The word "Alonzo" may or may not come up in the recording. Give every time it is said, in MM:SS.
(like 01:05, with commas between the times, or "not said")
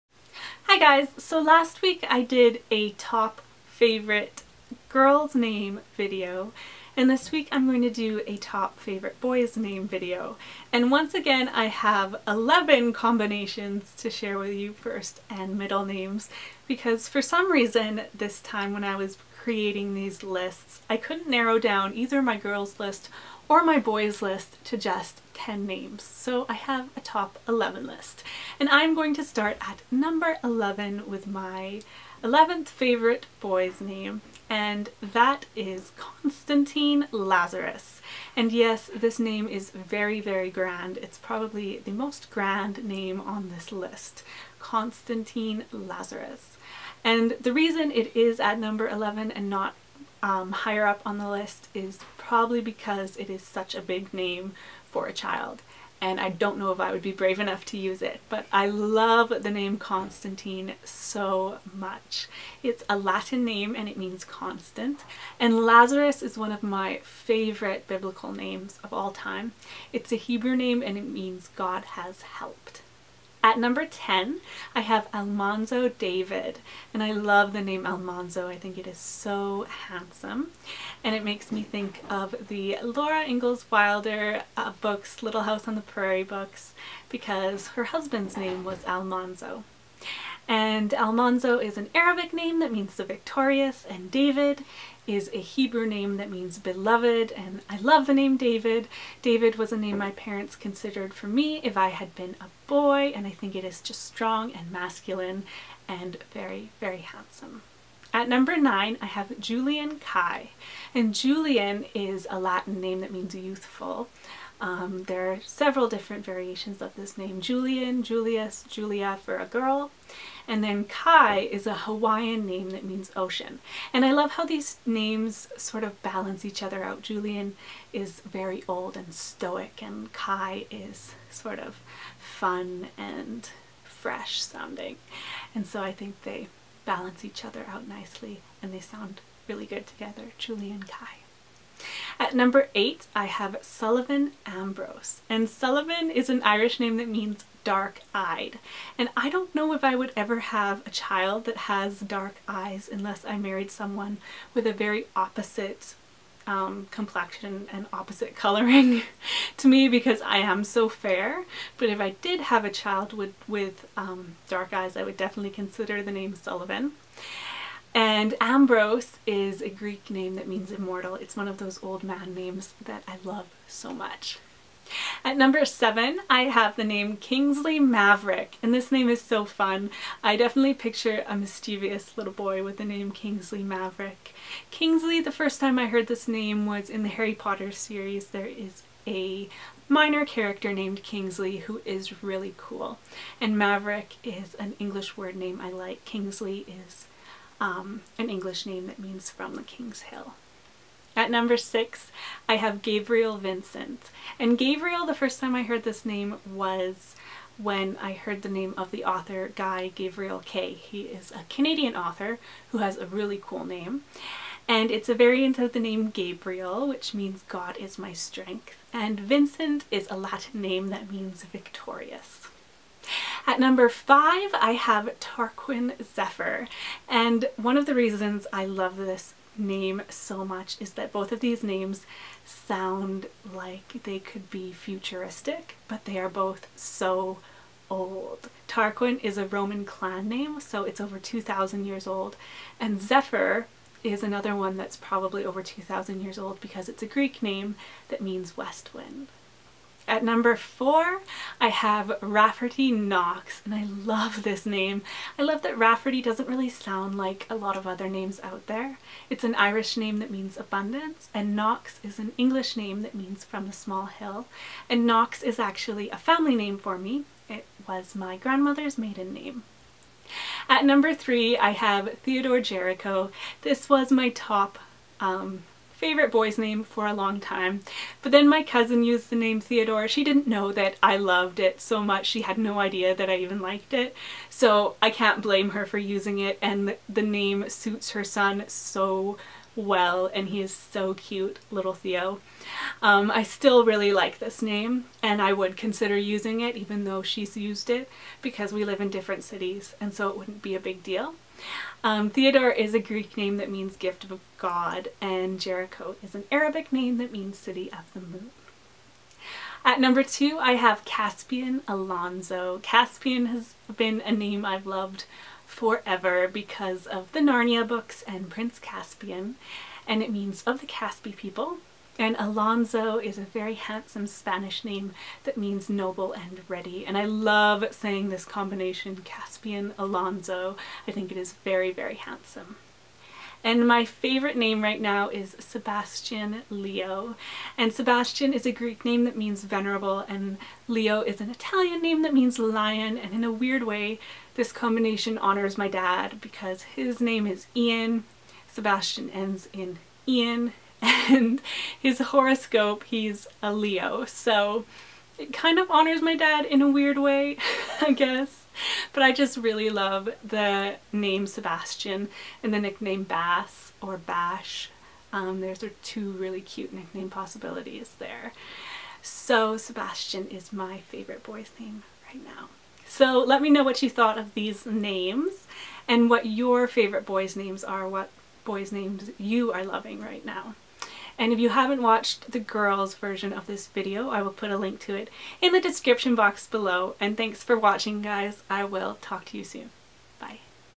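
05:11, 05:22, 05:29.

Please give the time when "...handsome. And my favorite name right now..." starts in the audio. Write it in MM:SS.
05:32.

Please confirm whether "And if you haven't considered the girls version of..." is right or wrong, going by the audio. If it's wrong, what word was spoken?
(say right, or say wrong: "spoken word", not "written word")
wrong: "watched", not "considered".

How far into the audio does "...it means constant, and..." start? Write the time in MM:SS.
01:03.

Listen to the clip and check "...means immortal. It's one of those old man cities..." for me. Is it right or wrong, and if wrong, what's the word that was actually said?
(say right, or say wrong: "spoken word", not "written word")
wrong: "names", not "cities".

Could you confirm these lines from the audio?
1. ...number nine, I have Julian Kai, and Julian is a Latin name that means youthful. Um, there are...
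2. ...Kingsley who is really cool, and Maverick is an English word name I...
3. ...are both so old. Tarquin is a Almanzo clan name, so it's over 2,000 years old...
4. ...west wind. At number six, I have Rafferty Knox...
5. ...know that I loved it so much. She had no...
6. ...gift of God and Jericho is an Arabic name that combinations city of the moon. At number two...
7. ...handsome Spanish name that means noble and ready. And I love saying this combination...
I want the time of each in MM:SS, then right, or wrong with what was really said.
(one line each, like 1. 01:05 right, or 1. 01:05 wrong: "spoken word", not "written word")
1. 01:48 right
2. 03:11 right
3. 03:56 wrong: "Roman", not "Almanzo"
4. 04:08 wrong: "four", not "six"
5. 04:40 right
6. 05:03 wrong: "means", not "combinations"
7. 05:23 right.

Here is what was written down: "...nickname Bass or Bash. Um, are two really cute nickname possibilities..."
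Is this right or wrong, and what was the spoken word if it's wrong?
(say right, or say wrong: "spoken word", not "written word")
right.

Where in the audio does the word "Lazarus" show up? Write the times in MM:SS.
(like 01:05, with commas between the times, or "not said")
00:37, 00:45, 01:05.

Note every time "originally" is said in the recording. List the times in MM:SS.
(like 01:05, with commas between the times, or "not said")
not said.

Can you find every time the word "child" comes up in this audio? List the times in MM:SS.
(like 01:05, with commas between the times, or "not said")
00:55, 02:30, 02:42.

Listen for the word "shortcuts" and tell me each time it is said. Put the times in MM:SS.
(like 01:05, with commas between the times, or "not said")
not said.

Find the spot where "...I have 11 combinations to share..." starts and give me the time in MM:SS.
00:11.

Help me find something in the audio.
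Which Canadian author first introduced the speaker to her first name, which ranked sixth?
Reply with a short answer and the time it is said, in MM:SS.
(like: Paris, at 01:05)
Guy Gavriel Kay, at 03:29.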